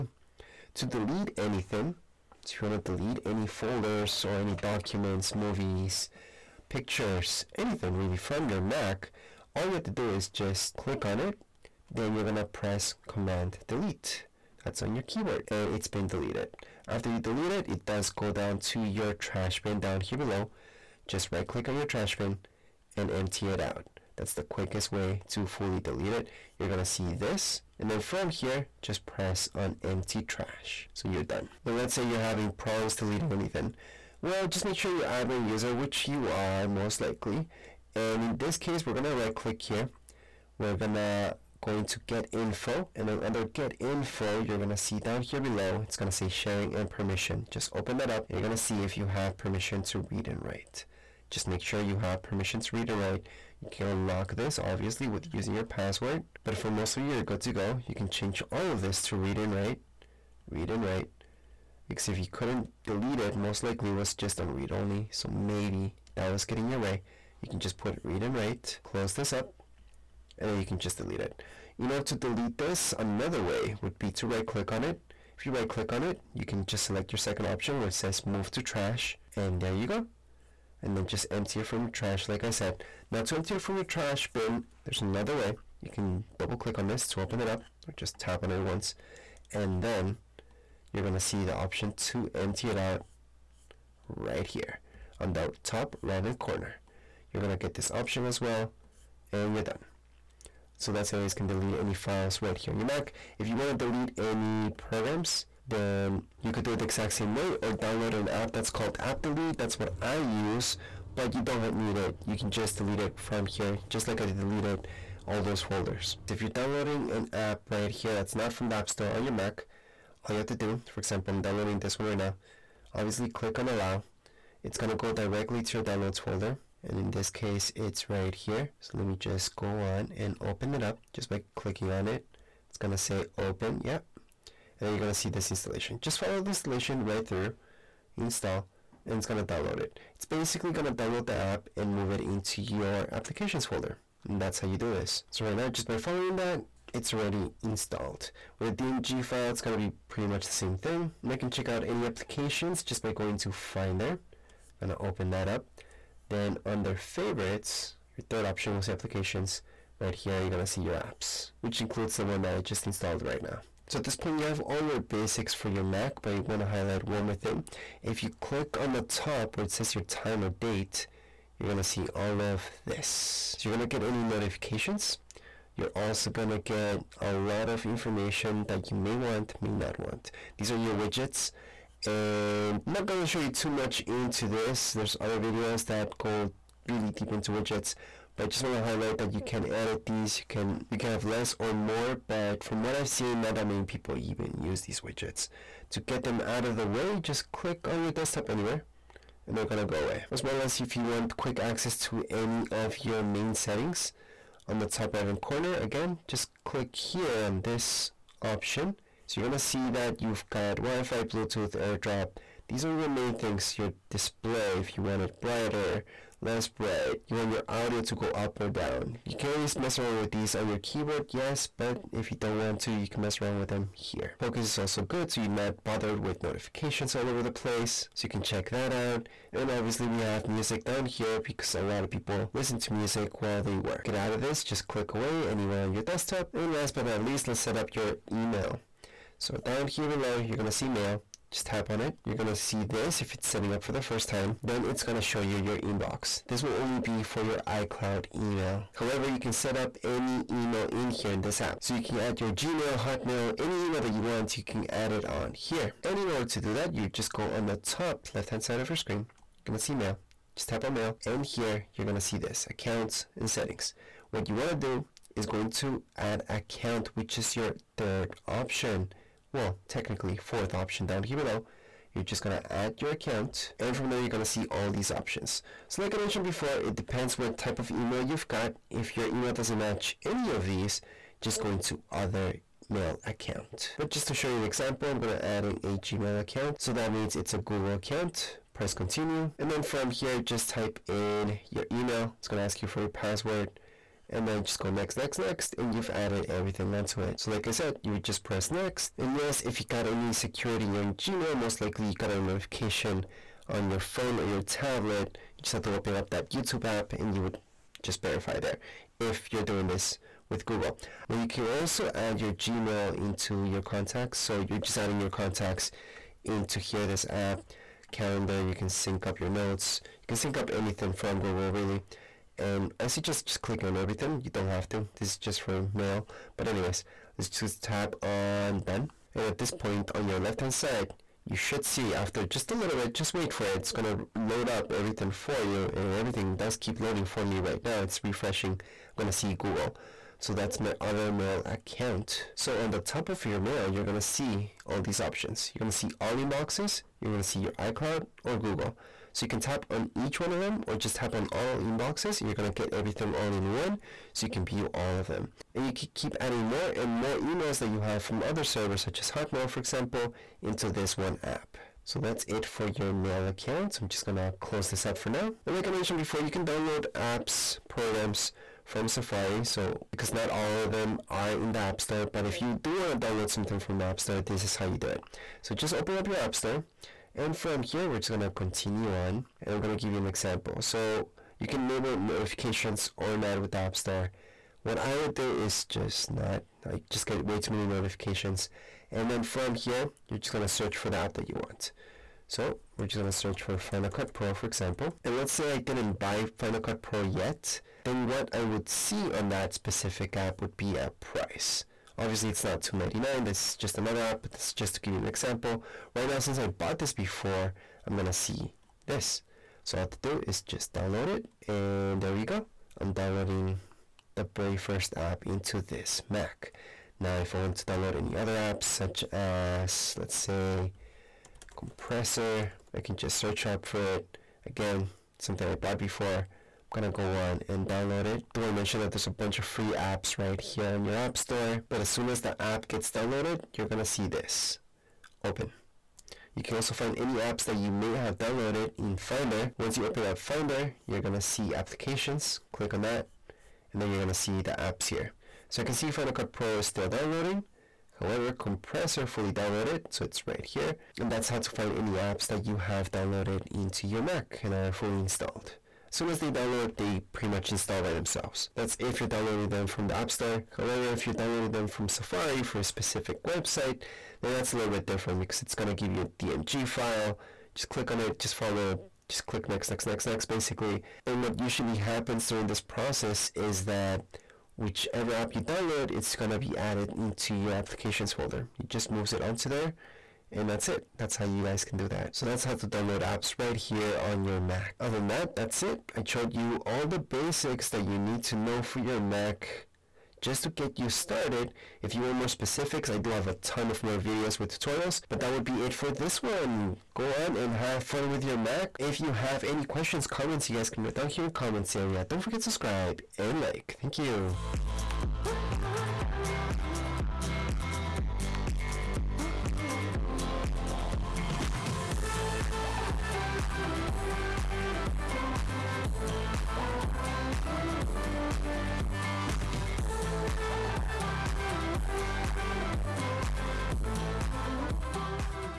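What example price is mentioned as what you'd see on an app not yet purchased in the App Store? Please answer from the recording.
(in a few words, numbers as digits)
$2.99.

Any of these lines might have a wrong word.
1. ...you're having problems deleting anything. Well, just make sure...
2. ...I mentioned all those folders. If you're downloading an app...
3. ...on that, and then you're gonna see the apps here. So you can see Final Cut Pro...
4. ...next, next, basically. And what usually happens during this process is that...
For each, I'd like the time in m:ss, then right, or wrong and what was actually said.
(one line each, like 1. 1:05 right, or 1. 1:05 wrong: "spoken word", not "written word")
1. 0:32 right
2. 1:54 wrong: "deleted", not "mentioned"
3. 7:22 right
4. 7:50 right.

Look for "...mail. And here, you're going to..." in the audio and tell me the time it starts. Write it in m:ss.
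4:20.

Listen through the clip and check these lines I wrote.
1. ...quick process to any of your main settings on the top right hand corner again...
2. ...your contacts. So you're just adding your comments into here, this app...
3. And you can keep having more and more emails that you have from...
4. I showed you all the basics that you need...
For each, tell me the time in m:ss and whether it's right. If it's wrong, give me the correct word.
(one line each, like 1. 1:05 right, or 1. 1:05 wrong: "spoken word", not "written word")
1. 3:21 wrong: "access", not "process"
2. 5:13 wrong: "contacts", not "comments"
3. 5:55 wrong: "adding", not "having"
4. 8:06 right.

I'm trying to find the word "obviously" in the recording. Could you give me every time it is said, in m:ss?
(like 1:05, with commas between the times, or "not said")
0:54, 2:02, 3:49, 6:42.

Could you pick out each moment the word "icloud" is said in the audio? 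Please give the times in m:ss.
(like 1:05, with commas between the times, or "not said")
4:07, 5:47.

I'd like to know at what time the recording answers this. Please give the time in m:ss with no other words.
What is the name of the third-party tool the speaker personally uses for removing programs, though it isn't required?
1:48.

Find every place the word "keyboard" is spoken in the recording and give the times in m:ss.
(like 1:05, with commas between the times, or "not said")
0:15, 3:40.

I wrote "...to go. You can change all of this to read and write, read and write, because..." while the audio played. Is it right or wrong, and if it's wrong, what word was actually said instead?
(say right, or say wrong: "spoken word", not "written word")
right.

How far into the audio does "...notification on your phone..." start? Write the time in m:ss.
5:02.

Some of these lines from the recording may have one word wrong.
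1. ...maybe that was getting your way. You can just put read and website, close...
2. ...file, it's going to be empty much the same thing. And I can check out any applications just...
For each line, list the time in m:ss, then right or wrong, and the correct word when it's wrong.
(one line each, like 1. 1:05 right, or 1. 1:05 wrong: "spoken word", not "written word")
1. 1:05 wrong: "write", not "website"
2. 2:29 wrong: "pretty", not "empty".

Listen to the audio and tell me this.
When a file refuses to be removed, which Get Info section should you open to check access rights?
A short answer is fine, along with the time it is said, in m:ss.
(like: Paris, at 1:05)
Sharing and permission, at 0:46.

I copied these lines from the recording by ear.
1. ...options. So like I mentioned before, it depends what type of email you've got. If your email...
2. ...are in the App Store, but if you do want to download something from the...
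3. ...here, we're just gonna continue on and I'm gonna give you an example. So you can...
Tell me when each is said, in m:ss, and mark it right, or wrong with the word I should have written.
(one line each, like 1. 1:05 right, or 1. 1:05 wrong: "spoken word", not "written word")
1. 4:35 right
2. 6:11 right
3. 6:17 right.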